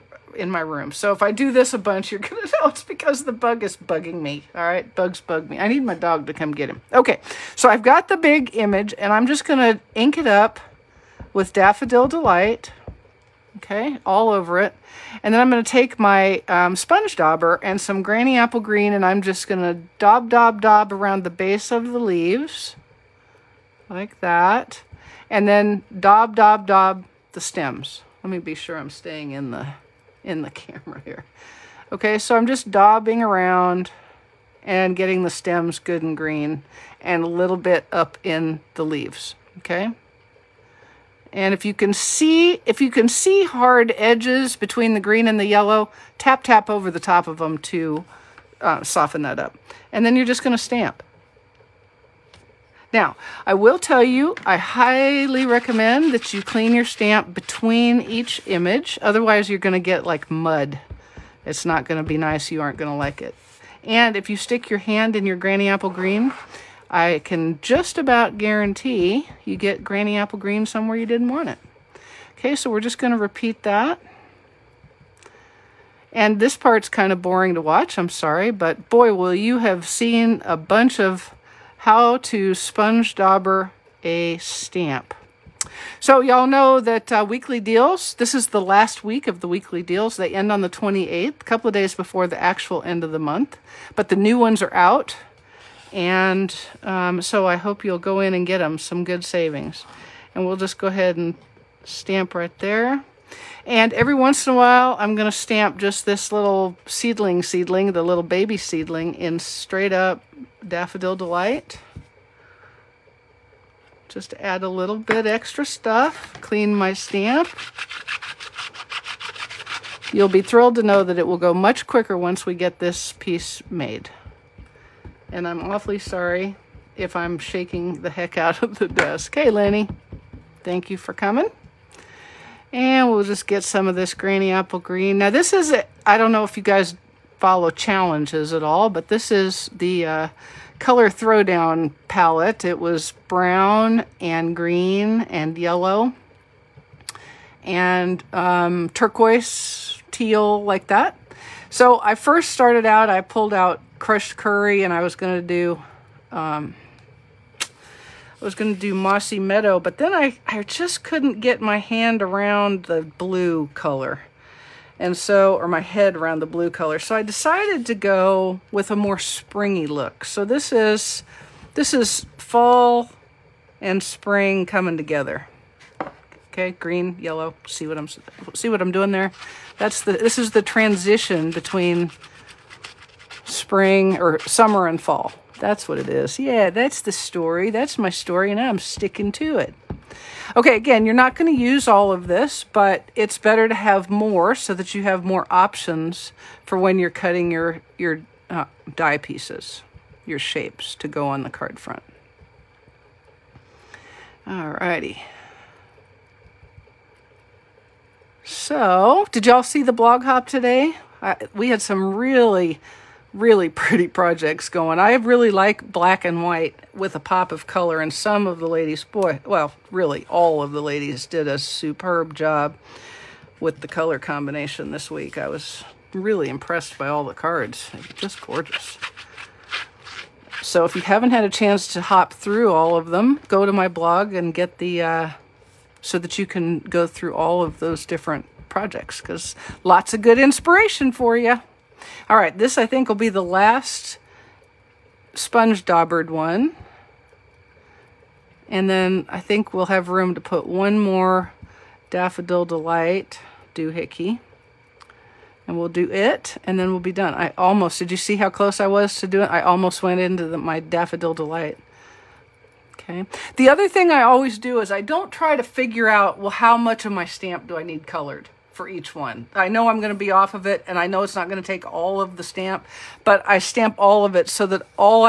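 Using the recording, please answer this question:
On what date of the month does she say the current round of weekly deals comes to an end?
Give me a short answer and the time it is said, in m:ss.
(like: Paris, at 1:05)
28th, at 1:30.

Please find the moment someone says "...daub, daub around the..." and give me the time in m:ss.
0:20.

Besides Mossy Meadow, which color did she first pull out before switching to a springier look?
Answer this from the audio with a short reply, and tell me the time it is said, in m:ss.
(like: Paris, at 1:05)
Crushed Curry, at 2:34.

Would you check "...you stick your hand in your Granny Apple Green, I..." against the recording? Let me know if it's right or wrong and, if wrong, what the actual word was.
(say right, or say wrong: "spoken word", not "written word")
right.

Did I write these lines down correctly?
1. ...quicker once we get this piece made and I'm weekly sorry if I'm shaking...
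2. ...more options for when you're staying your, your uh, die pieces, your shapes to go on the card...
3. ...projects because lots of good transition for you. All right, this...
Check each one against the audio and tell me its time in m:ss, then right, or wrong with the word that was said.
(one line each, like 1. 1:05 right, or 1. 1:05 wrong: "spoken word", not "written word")
1. 2:01 wrong: "awfully", not "weekly"
2. 3:15 wrong: "cutting", not "staying"
3. 3:58 wrong: "inspiration", not "transition".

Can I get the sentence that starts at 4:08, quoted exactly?
And then I think we'll have room to put one more Daffodil Delight doohickey.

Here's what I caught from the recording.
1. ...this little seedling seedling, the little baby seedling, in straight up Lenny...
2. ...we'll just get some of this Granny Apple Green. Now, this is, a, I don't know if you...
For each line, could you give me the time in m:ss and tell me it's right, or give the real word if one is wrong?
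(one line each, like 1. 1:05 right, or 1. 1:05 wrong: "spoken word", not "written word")
1. 1:46 wrong: "Daffodil", not "Lenny"
2. 2:13 right.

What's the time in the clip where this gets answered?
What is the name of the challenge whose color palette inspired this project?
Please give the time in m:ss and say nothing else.
2:20.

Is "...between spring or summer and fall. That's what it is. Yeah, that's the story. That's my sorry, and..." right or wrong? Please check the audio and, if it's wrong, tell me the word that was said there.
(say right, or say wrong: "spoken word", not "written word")
wrong: "story", not "sorry".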